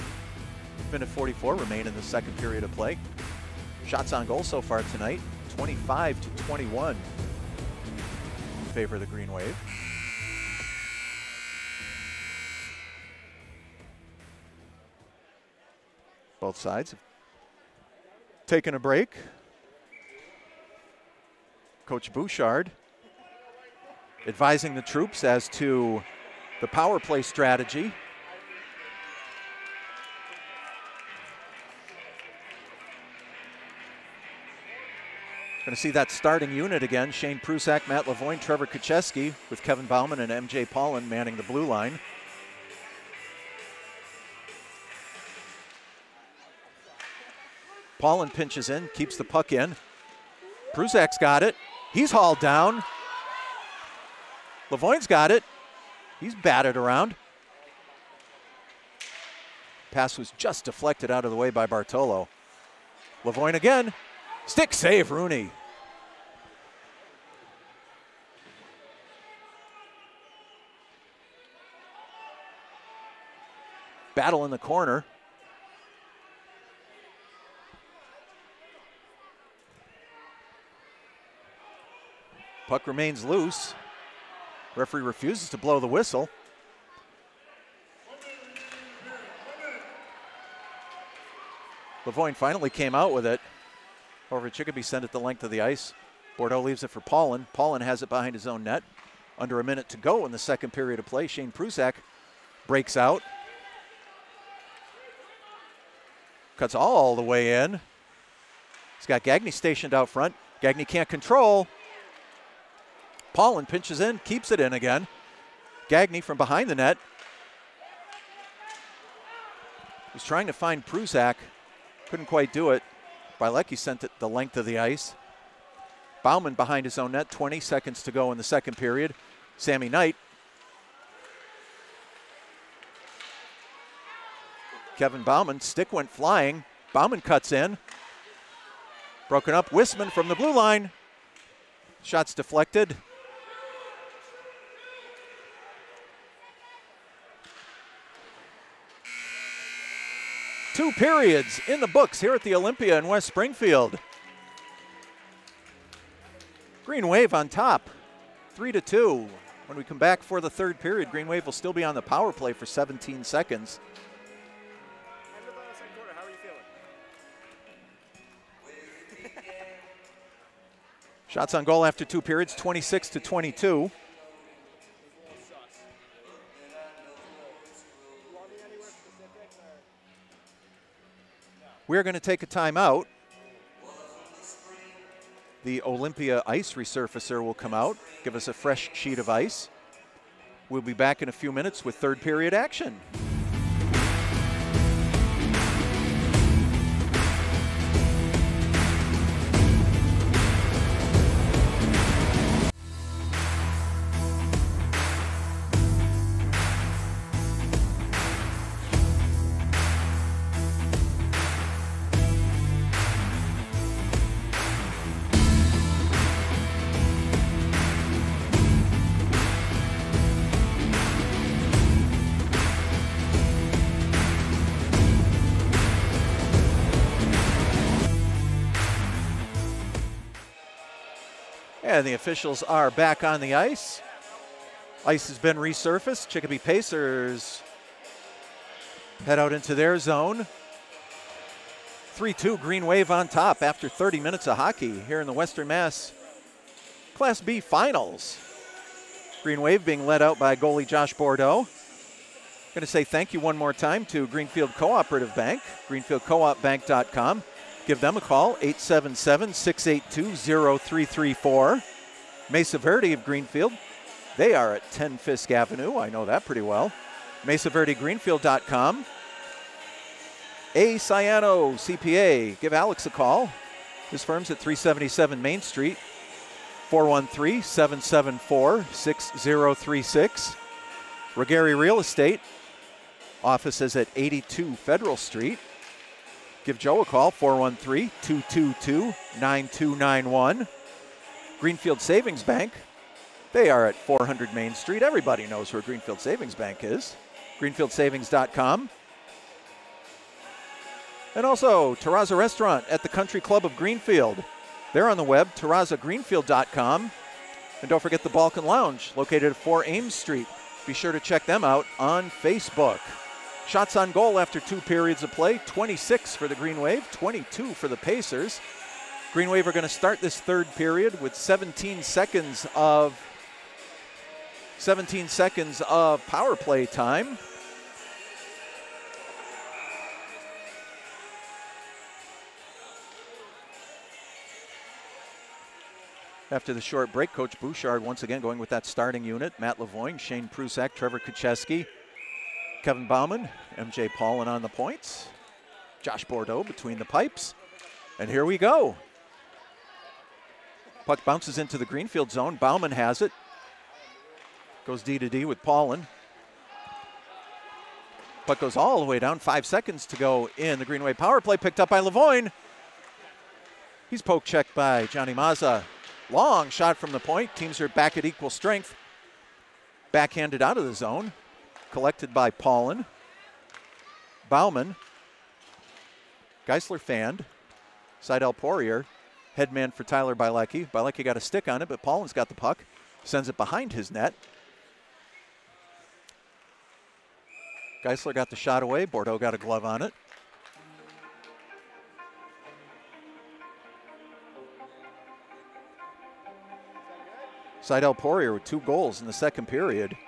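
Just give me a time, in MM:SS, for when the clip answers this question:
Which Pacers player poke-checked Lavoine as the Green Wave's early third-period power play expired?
06:05.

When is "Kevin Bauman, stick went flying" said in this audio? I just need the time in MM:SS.
02:14.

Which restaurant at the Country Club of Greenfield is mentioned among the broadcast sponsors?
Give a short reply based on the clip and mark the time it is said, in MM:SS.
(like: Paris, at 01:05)
Terraza Restaurant, at 05:01.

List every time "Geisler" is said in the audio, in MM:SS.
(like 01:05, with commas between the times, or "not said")
06:16, 06:28.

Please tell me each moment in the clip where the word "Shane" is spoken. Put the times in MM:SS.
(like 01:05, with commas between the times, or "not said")
00:37, 01:41, 05:40.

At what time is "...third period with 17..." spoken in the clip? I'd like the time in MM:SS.
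05:20.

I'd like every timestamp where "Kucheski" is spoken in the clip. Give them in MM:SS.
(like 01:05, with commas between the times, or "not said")
00:38, 05:41.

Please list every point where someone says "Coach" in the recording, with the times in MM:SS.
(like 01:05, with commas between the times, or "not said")
00:21, 05:37.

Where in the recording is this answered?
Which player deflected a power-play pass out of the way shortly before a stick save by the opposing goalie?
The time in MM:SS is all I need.
01:01.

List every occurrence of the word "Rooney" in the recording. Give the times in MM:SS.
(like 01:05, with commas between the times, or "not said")
01:05.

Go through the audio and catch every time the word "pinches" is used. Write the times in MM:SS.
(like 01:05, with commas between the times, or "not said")
00:48, 01:53.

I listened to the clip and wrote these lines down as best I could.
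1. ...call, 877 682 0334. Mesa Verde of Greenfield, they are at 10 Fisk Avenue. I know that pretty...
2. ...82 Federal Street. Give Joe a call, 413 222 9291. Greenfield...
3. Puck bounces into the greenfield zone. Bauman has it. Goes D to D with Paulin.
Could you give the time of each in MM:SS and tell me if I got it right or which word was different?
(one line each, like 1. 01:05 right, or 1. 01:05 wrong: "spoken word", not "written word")
1. 04:18 right
2. 04:44 right
3. 05:51 right.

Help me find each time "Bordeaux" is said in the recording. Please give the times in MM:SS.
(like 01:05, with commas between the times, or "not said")
01:36, 04:11, 05:46, 06:29.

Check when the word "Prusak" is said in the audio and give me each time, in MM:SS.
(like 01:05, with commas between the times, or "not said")
00:37, 00:50, 01:41, 02:00, 05:40.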